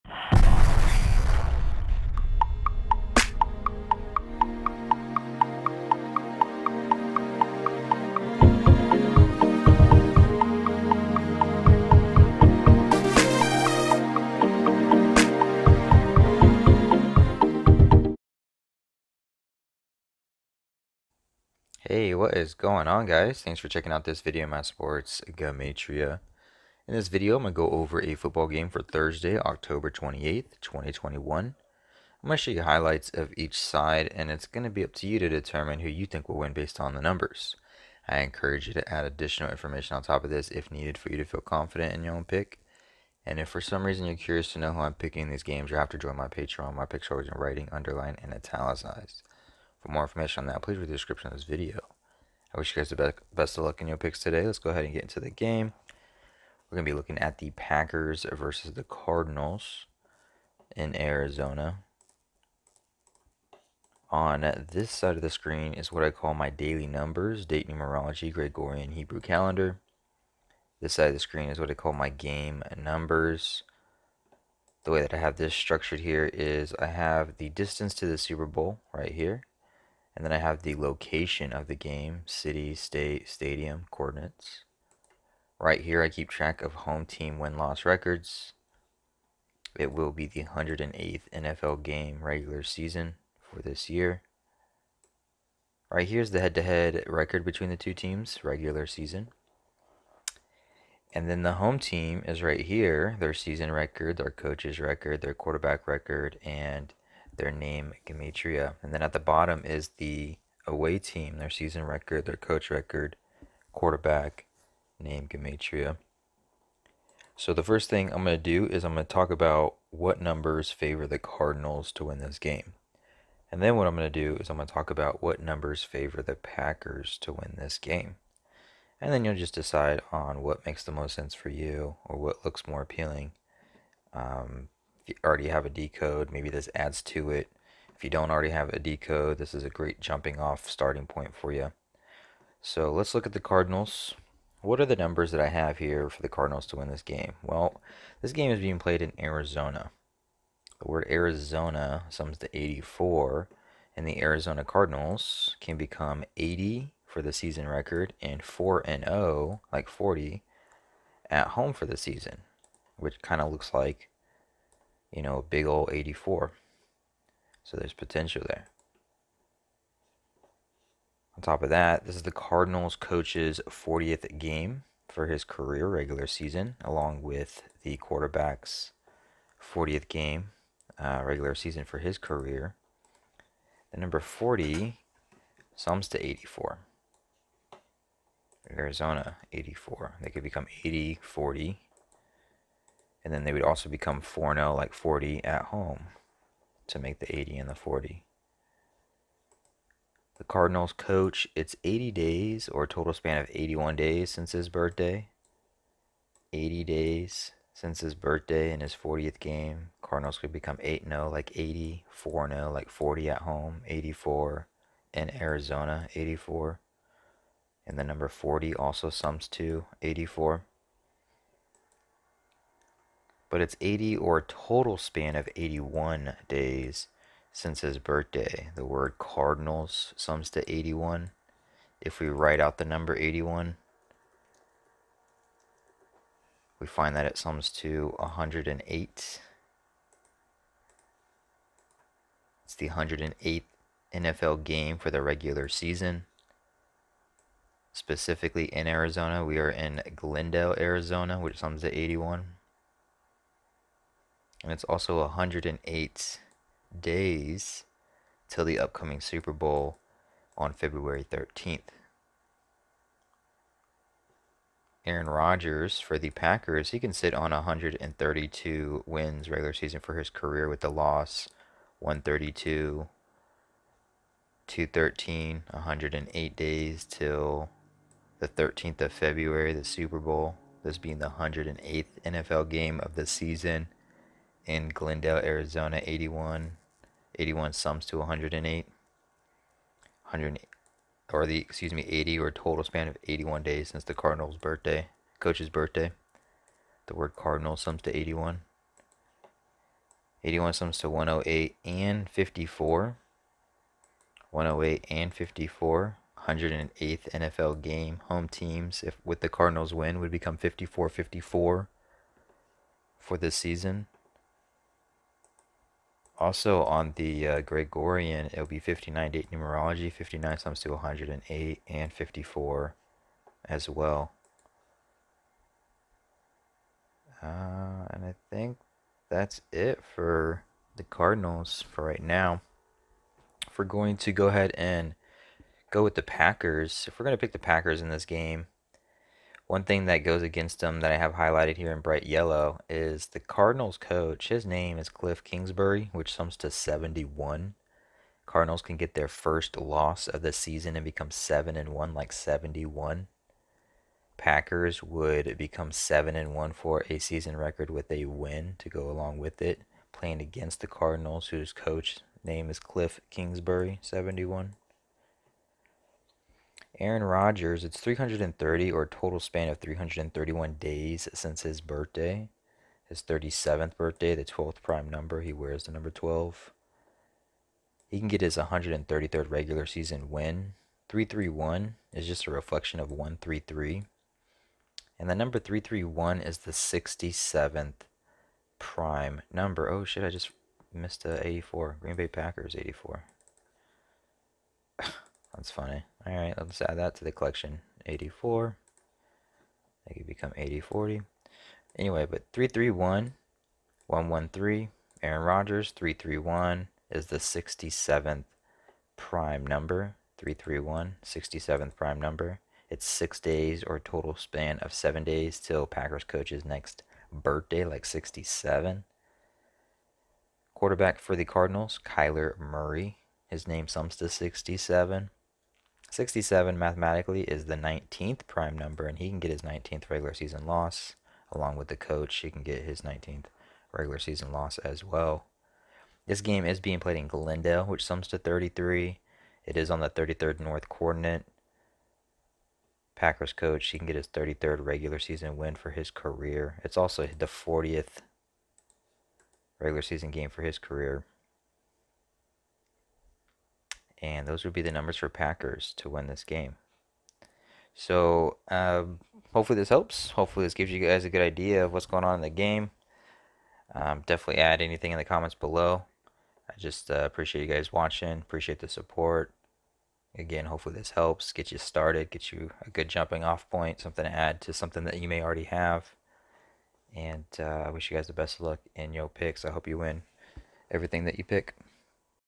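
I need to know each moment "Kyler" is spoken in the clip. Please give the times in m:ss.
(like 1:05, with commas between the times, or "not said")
7:02.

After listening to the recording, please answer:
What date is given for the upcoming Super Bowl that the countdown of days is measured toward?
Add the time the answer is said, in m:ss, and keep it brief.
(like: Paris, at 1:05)
February 13th, at 4:20.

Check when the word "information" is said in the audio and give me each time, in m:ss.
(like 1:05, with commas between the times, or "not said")
0:39, 0:50.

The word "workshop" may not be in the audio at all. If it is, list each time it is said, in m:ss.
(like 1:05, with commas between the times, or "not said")
not said.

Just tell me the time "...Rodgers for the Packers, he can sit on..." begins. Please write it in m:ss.
4:25.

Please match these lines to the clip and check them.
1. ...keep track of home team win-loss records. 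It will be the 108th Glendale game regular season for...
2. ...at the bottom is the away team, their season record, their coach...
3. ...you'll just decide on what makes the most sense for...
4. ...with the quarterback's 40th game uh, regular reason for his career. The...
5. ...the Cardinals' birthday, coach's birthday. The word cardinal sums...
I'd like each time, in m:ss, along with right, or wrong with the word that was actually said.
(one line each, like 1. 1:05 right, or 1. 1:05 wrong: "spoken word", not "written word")
1. 1:26 wrong: "NFL", not "Glendale"
2. 1:49 right
3. 2:09 right
4. 2:57 wrong: "season", not "reason"
5. 4:54 right.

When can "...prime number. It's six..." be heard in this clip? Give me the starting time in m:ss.
6:51.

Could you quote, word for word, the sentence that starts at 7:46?
I just uh, appreciate you guys watching.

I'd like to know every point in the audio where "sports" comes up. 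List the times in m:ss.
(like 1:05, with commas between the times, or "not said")
0:24.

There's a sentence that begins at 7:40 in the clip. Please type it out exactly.
Hopefully this gives you guys a good idea of what's going on in the game.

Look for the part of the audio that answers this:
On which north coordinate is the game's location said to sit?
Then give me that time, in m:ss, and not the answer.
7:20.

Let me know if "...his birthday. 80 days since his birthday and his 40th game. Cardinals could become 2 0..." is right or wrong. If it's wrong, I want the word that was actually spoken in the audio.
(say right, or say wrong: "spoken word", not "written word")
wrong: "8", not "2".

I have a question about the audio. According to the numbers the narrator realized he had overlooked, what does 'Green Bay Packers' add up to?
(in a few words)
84.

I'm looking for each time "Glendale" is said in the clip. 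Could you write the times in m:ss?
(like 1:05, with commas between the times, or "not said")
4:10, 4:44, 7:17.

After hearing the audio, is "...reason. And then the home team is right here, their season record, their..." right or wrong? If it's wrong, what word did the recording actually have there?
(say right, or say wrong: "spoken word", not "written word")
wrong: "season", not "reason".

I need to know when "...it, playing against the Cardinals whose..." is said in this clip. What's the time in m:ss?
5:59.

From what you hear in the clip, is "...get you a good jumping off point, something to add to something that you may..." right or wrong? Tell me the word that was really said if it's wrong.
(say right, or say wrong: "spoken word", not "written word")
right.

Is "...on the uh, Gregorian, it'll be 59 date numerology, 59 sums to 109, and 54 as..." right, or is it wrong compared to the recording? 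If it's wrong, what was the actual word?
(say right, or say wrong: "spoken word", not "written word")
wrong: "108", not "109".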